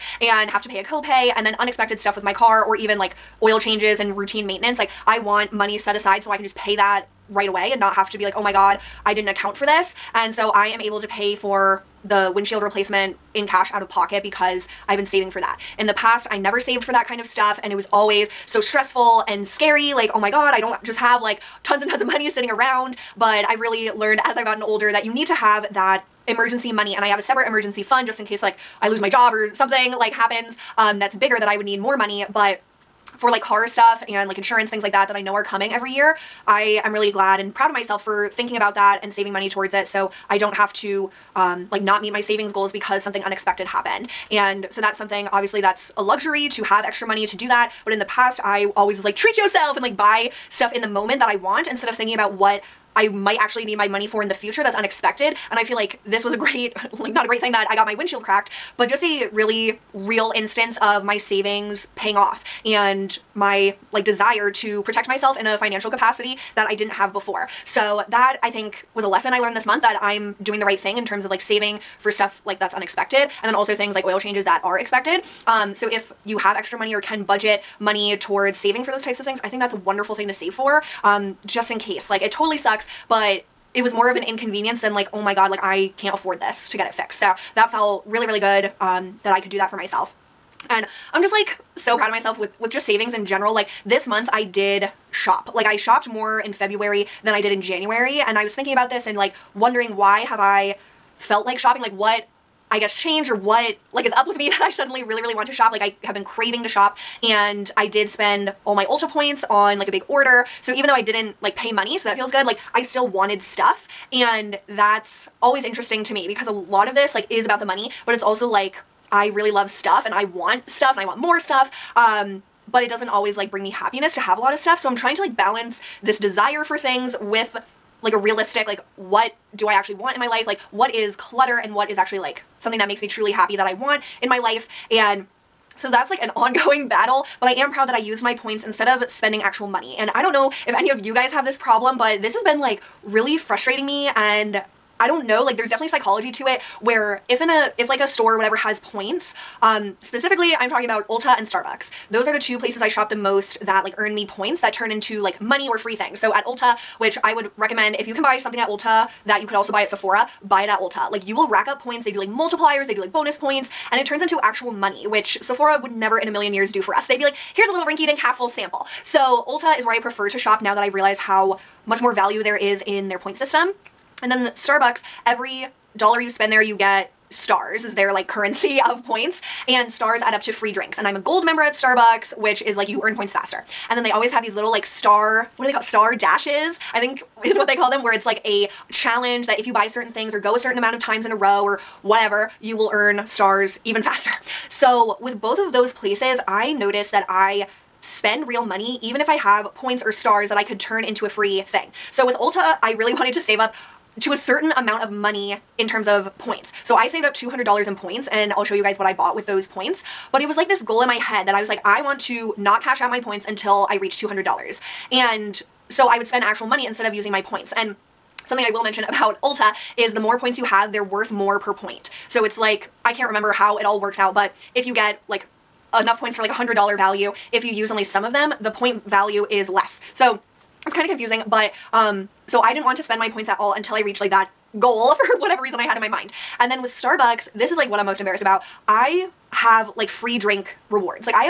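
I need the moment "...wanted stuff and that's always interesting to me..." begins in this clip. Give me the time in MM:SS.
01:53.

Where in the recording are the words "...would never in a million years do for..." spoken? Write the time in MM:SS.
02:45.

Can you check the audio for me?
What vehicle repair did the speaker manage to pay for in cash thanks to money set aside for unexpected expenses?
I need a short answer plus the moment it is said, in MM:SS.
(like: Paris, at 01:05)
windshield replacement, at 00:12.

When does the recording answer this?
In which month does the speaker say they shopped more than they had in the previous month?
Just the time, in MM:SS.
01:36.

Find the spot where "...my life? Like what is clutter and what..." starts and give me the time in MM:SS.
02:10.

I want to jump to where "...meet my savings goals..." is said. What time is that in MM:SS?
00:42.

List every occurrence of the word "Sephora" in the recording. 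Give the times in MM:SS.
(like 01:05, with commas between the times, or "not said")
02:39, 02:45.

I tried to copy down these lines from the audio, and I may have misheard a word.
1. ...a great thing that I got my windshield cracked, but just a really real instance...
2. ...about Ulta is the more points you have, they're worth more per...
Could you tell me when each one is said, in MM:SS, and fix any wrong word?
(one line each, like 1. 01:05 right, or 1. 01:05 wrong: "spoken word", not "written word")
1. 00:57 right
2. 03:39 right.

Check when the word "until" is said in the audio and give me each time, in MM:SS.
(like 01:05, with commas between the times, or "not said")
03:33, 03:53.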